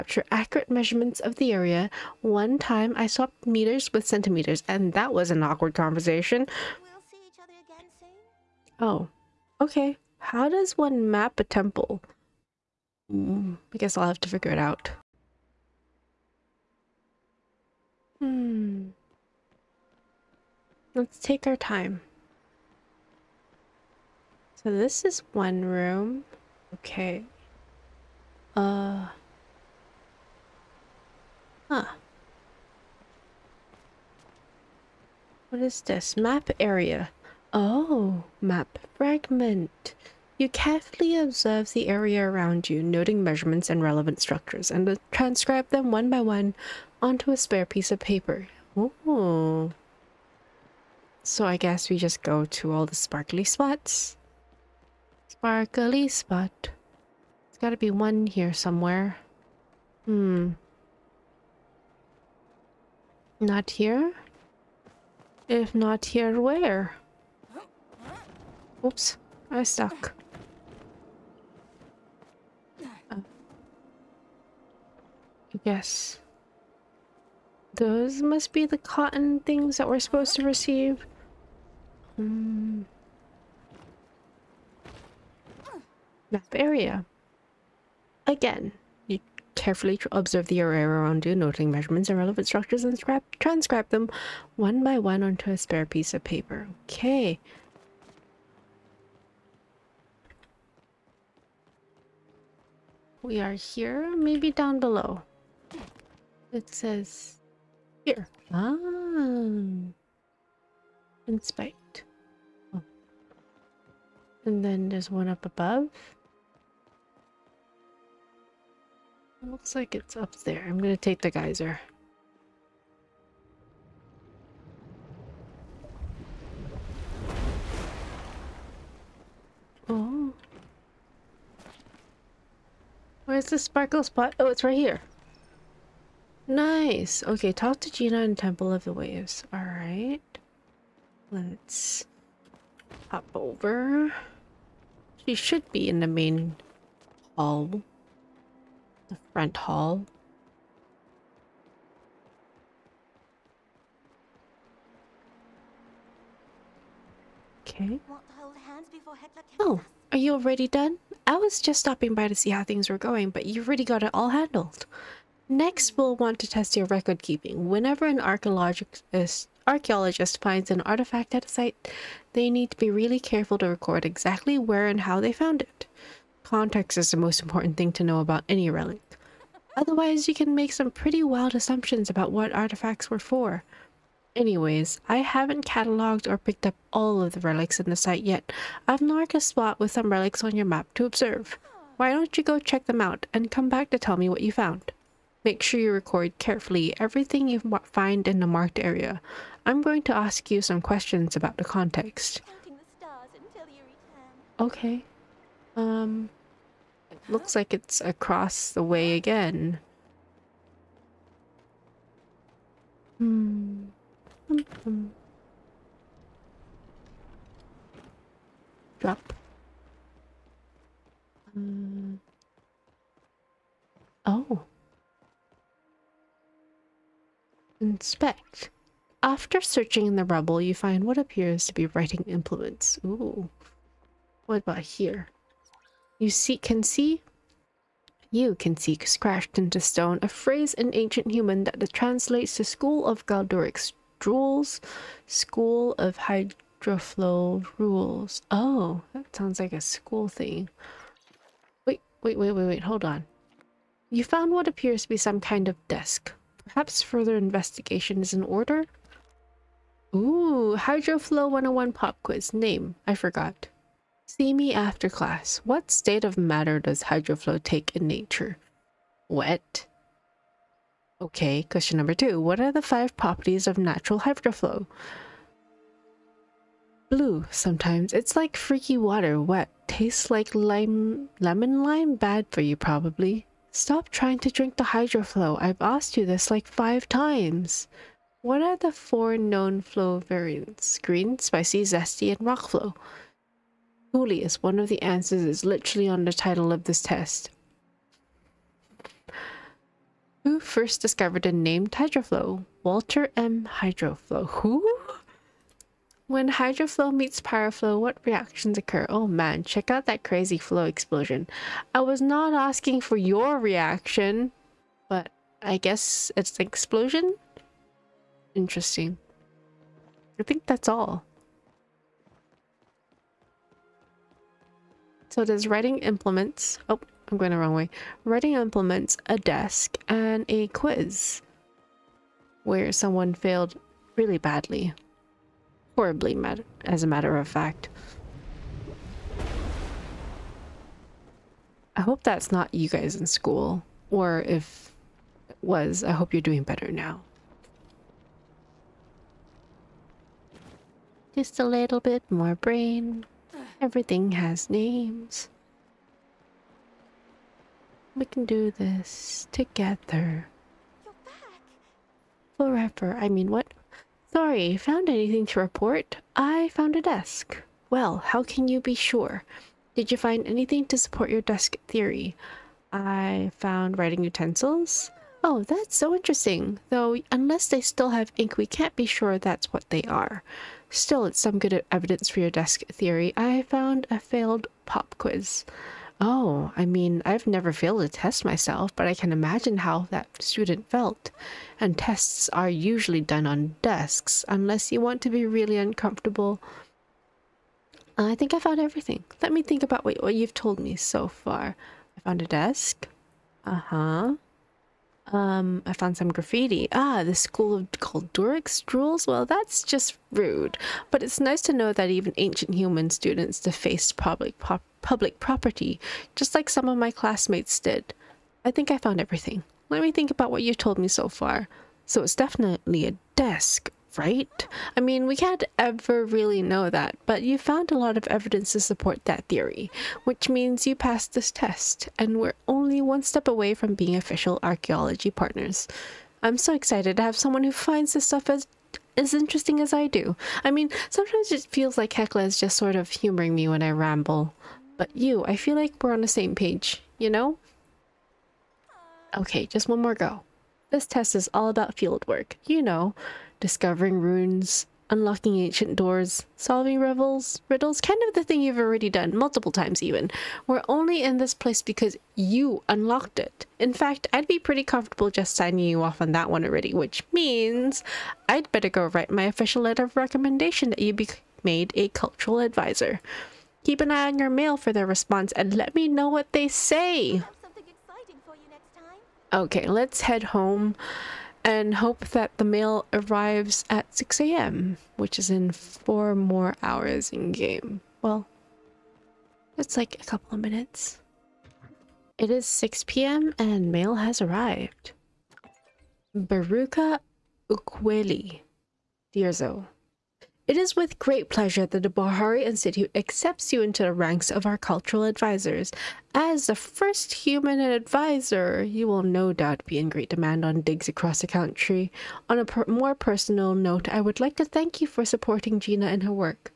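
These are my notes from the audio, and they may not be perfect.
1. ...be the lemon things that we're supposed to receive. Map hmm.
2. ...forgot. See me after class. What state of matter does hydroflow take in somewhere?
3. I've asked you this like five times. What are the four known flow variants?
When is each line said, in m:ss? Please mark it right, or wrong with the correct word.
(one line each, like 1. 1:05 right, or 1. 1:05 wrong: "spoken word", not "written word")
1. 1:18 wrong: "cotton", not "lemon"
2. 4:23 wrong: "nature", not "somewhere"
3. 4:45 right.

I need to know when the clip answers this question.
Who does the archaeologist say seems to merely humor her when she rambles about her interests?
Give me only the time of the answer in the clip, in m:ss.
7:22.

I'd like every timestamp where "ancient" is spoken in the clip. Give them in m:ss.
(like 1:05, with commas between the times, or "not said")
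4:00, 6:52, 7:35.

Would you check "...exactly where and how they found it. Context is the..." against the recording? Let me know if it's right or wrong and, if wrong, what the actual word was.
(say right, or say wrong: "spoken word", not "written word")
right.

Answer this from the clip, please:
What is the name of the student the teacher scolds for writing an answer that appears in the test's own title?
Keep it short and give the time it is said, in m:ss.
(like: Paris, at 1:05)
Julius, at 4:54.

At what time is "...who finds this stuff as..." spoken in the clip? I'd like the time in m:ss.
7:17.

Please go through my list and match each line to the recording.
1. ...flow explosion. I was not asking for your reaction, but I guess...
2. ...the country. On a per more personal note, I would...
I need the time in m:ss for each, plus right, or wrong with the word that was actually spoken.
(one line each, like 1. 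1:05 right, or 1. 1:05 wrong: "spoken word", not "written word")
1. 5:10 right
2. 8:31 right.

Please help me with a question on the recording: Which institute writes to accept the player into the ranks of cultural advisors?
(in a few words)
Bahari Institute.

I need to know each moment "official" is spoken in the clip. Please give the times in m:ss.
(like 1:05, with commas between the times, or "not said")
7:14, 7:49.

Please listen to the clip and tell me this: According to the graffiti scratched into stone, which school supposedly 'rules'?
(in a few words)
School of Hydroflow.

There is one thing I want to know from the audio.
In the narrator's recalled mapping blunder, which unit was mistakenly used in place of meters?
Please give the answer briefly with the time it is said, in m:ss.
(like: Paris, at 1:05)
centimeters, at 0:04.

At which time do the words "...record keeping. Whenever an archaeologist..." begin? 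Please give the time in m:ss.
2:46.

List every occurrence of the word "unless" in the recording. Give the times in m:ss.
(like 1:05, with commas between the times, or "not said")
6:17, 6:34.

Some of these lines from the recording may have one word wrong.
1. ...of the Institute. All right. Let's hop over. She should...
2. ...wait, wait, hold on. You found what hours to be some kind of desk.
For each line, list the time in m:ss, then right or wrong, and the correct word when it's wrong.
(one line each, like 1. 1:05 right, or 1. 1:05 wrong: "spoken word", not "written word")
1. 2:18 wrong: "Waves", not "Institute"
2. 4:12 wrong: "appears", not "hours".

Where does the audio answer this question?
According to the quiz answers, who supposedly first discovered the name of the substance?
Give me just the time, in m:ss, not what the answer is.
5:02.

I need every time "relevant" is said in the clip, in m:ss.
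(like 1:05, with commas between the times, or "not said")
0:43, 1:32.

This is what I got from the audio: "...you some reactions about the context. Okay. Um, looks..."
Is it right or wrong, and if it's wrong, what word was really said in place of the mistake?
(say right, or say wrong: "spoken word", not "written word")
wrong: "questions", not "reactions".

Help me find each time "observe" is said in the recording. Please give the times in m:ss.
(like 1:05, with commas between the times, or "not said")
0:41, 1:30, 3:11.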